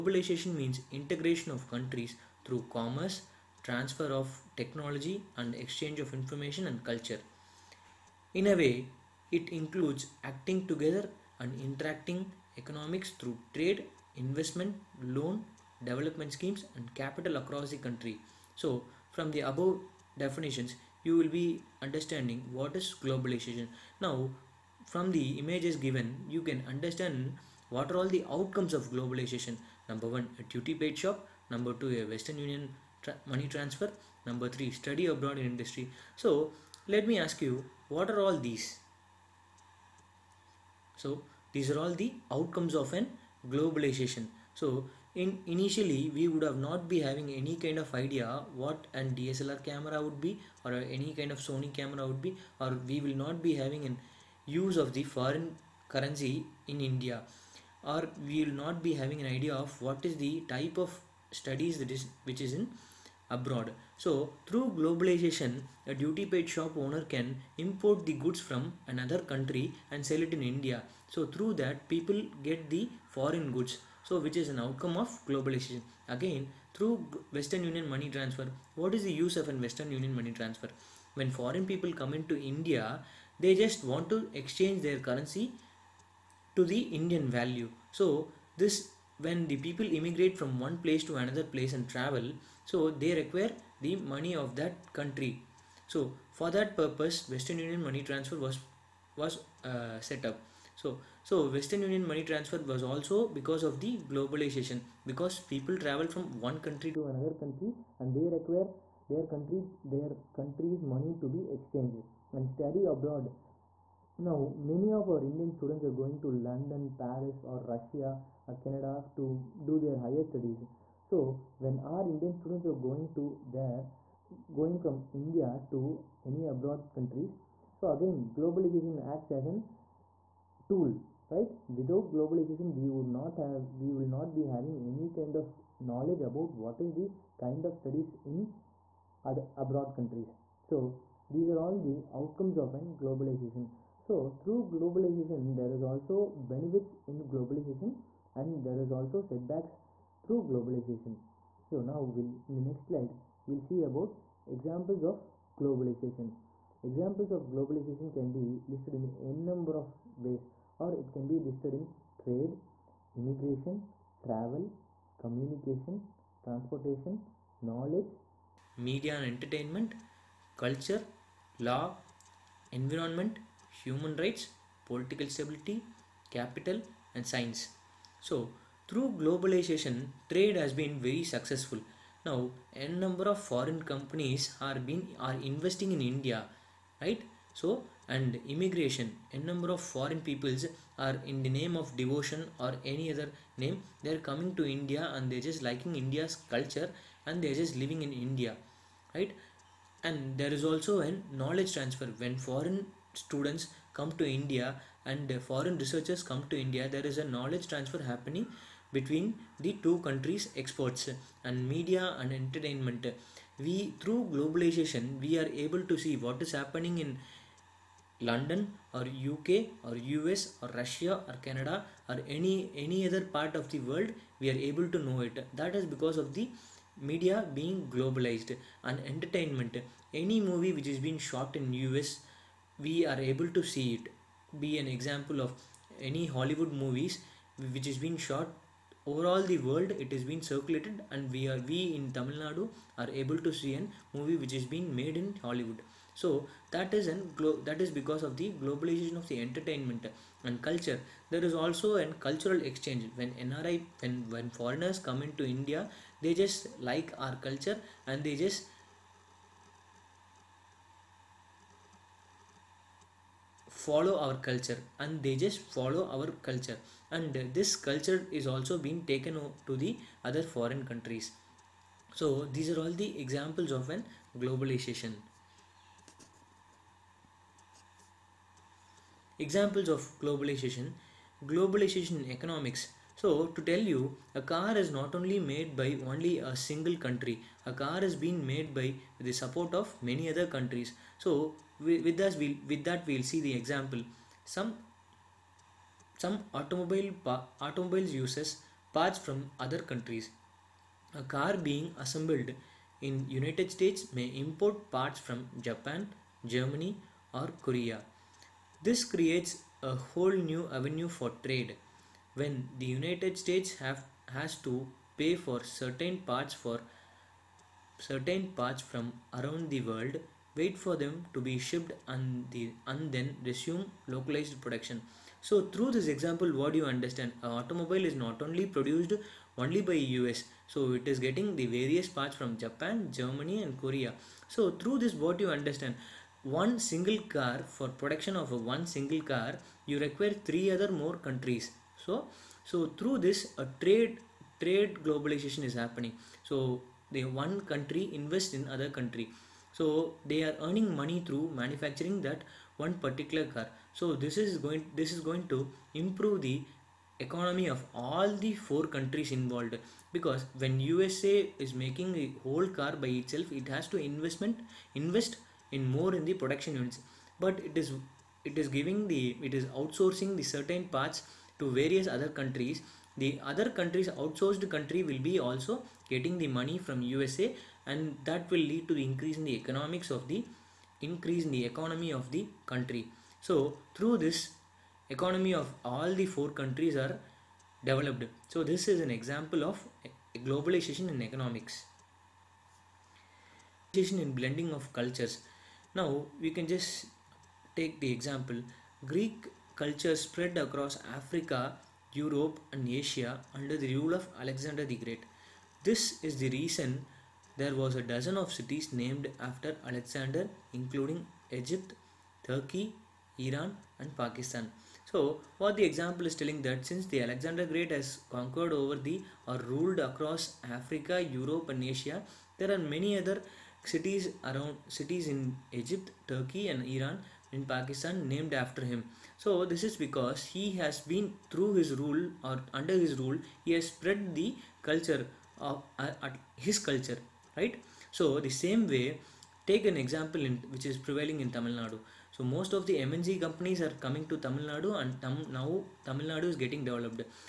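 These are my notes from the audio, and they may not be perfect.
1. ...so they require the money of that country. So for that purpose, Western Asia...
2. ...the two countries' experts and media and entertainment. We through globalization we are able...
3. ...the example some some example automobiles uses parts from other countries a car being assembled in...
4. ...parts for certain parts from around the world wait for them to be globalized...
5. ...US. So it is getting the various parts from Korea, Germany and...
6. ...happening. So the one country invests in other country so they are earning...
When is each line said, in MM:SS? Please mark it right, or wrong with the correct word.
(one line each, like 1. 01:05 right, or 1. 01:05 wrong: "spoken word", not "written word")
1. 01:32 wrong: "Union", not "Asia"
2. 03:29 right
3. 04:53 wrong: "automobile", not "example"
4. 05:16 wrong: "shipped", not "globalized"
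5. 05:29 wrong: "Japan", not "Korea"
6. 05:45 right.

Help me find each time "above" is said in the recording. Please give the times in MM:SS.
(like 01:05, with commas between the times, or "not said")
00:19.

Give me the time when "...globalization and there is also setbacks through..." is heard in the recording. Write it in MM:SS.
02:27.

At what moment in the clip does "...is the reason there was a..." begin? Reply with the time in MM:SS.
06:46.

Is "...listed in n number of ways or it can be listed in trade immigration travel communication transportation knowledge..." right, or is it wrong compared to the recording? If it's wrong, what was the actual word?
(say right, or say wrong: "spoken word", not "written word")
right.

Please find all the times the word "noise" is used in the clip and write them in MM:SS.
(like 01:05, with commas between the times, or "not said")
not said.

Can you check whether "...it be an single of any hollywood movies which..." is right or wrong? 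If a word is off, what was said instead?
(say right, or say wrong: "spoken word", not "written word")
wrong: "example", not "single".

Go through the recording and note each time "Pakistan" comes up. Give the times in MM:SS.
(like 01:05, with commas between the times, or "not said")
06:54, 07:07.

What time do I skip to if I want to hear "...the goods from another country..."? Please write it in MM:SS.
01:08.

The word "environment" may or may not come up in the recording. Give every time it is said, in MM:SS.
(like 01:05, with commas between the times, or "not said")
02:52.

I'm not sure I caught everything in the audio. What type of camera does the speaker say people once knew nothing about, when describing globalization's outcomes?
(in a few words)
DSLR camera.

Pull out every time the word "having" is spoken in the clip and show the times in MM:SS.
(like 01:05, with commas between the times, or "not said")
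00:47, 00:53, 00:58, 02:14.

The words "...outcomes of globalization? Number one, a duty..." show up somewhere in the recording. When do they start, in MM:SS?
00:28.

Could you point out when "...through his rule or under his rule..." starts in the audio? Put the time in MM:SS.
07:11.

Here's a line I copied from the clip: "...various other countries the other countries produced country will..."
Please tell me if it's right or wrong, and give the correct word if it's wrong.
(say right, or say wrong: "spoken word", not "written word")
wrong: "outsourced", not "produced".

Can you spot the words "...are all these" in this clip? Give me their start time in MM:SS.
00:38.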